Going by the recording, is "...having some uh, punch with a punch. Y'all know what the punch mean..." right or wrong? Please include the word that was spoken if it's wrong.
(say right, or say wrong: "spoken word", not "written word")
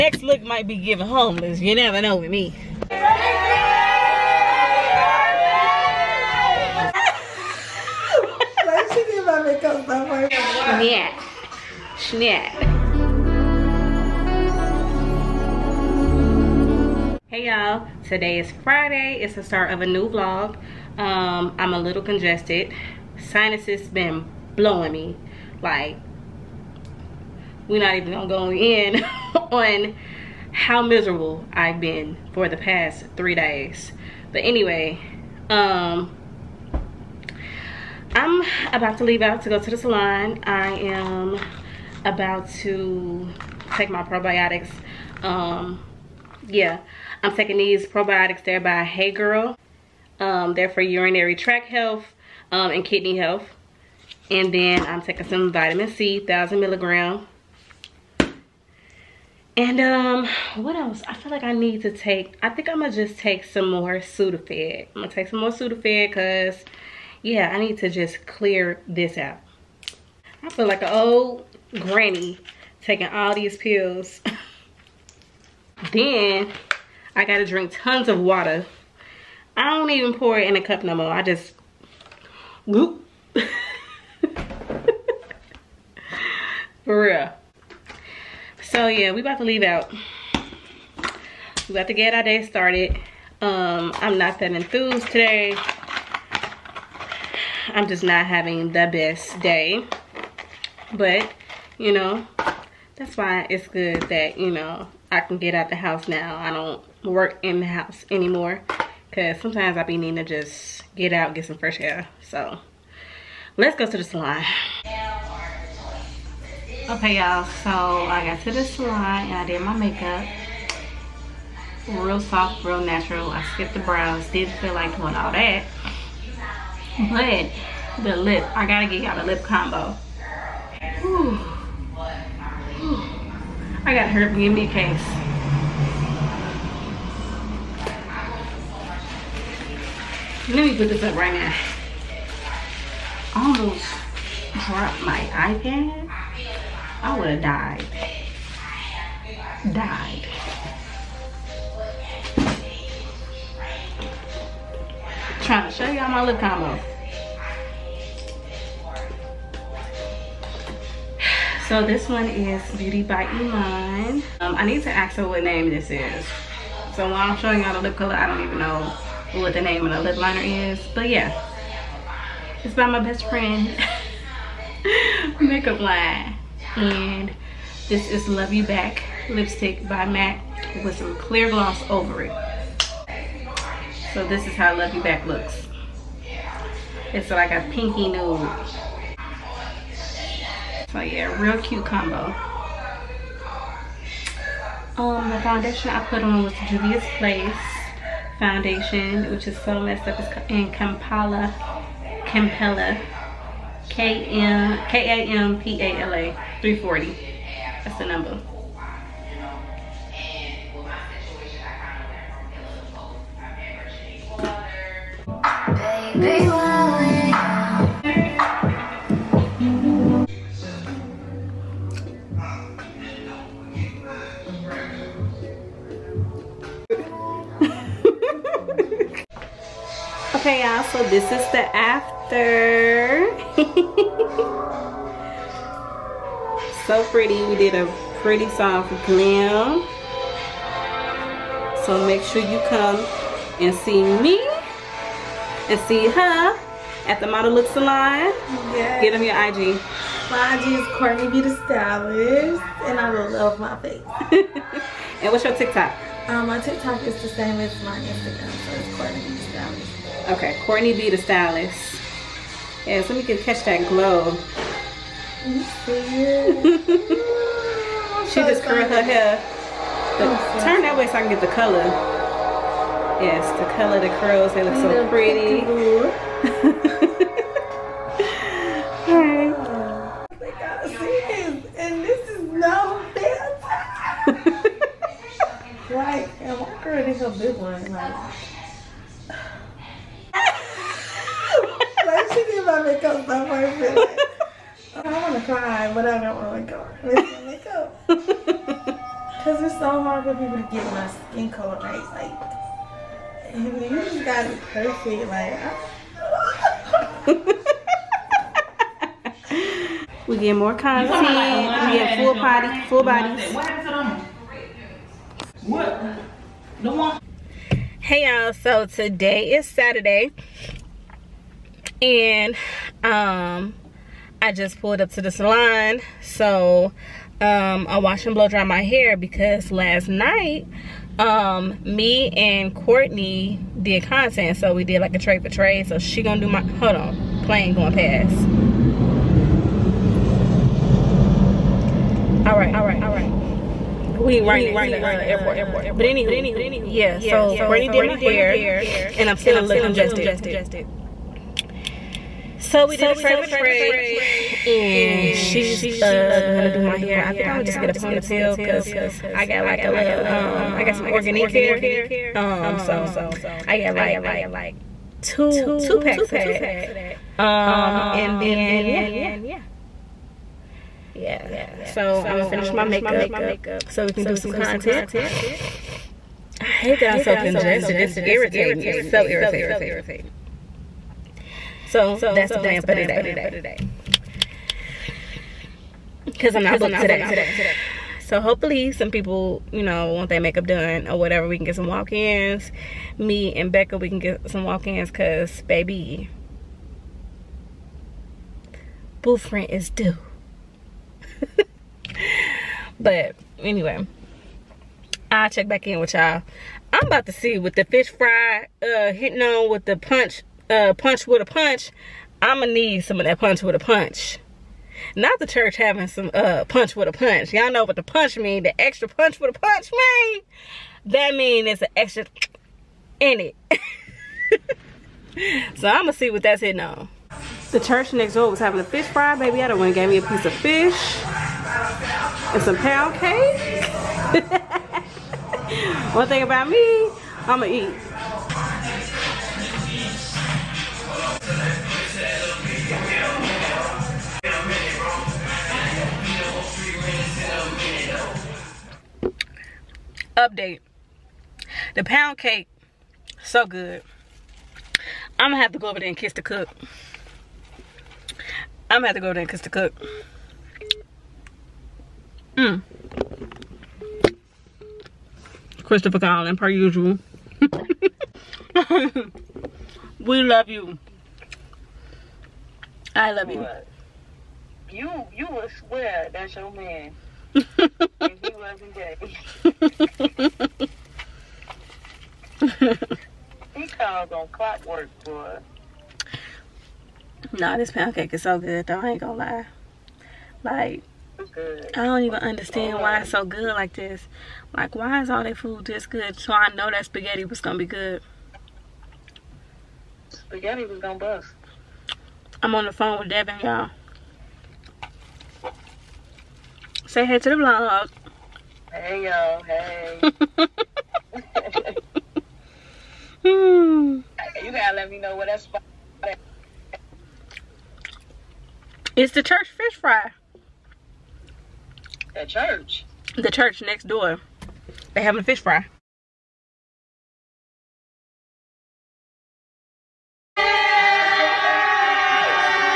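right.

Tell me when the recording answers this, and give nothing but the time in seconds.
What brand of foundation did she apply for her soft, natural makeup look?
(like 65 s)
196 s.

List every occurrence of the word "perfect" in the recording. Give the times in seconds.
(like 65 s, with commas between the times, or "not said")
293 s, 304 s.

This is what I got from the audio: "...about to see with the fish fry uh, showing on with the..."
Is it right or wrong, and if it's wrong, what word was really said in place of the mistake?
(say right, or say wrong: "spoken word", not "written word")
wrong: "hitting", not "showing".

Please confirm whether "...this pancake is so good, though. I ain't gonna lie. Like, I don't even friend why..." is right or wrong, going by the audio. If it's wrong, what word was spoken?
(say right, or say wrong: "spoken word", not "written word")
wrong: "understand", not "friend".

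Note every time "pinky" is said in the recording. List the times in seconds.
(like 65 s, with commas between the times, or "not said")
187 s.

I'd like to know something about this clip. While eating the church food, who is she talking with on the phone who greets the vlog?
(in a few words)
Devin.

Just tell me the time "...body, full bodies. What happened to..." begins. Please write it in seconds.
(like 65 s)
312 s.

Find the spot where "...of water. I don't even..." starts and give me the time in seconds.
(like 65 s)
78 s.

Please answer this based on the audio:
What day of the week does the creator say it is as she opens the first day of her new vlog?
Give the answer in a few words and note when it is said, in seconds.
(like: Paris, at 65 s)
Friday, at 18 s.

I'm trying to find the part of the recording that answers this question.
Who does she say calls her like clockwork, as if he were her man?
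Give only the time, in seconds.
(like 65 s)
465 s.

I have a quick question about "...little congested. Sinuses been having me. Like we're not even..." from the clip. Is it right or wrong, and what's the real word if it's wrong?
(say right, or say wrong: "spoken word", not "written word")
wrong: "blowing", not "having".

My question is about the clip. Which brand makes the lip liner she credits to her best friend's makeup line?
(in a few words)
Beauty by Iman.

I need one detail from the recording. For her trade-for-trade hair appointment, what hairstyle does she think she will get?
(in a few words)
Ponytail.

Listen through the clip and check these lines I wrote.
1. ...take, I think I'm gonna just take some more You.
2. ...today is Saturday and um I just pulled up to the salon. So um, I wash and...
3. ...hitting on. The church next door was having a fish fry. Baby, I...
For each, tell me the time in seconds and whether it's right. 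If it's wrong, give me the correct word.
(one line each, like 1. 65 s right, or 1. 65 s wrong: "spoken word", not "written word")
1. 61 s wrong: "Sudafed", not "You"
2. 318 s right
3. 426 s right.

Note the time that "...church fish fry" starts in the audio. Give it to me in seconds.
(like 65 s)
519 s.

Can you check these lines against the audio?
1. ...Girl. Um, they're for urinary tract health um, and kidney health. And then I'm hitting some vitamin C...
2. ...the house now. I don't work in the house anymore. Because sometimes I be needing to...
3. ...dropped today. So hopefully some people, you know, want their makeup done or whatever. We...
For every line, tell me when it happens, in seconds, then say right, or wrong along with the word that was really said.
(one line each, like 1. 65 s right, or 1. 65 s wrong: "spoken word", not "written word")
1. 49 s wrong: "taking", not "hitting"
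2. 105 s right
3. 386 s wrong: "booked", not "dropped".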